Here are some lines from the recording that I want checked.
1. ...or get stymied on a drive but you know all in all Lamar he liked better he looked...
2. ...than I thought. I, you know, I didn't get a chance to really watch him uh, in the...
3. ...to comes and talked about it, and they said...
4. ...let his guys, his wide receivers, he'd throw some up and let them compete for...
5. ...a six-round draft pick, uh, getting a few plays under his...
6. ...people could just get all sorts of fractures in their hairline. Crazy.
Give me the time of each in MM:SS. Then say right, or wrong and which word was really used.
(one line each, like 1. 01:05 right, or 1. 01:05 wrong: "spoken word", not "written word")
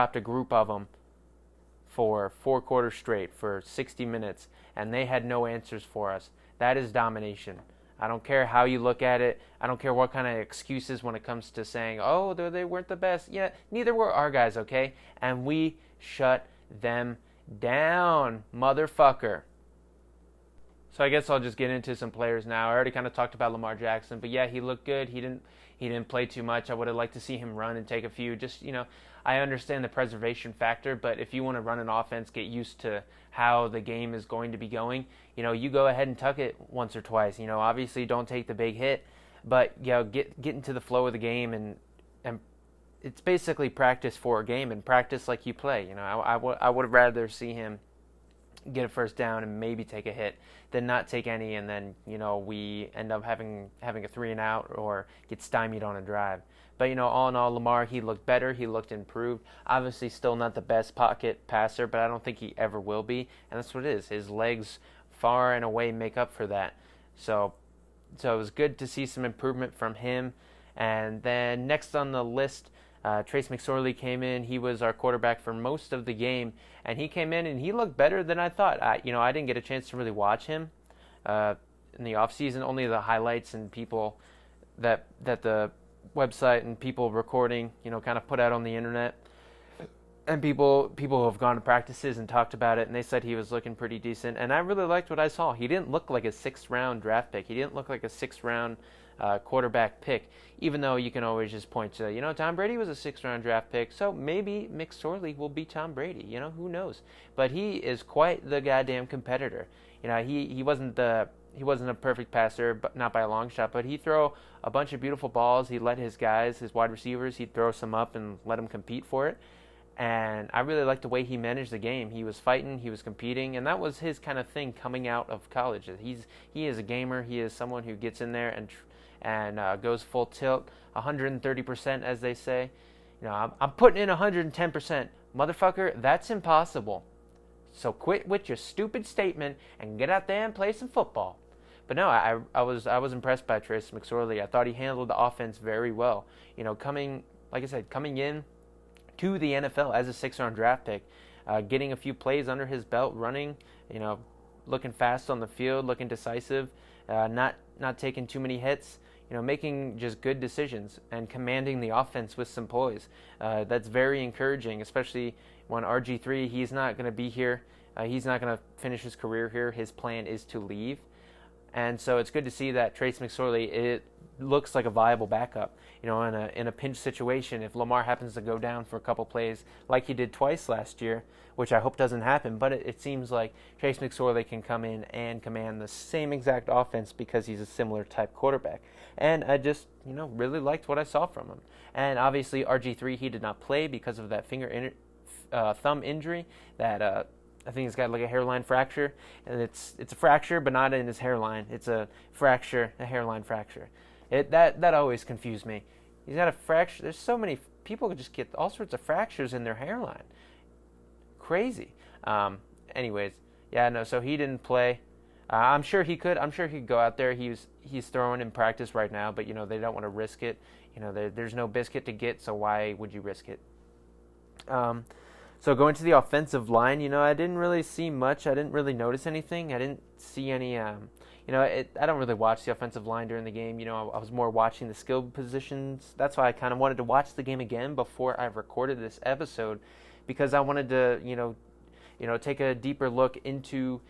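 1. 00:54 wrong: "looked", not "liked"
2. 01:18 right
3. 01:31 wrong: "practices", not "comes"
4. 01:55 right
5. 02:30 right
6. 03:27 right.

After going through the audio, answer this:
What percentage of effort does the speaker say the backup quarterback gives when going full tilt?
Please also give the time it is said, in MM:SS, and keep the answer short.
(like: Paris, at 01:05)
130%, at 02:10.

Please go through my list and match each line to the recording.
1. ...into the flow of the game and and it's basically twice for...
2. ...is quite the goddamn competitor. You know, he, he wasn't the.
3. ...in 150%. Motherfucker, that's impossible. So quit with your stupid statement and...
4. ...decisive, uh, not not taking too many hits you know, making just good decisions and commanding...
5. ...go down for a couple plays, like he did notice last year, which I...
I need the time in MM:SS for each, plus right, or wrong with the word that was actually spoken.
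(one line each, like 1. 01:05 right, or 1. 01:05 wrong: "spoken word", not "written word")
1. 00:40 wrong: "practice", not "twice"
2. 01:47 right
3. 02:13 wrong: "110", not "150"
4. 02:36 right
5. 02:58 wrong: "twice", not "notice".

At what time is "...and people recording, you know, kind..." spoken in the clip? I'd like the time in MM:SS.
01:26.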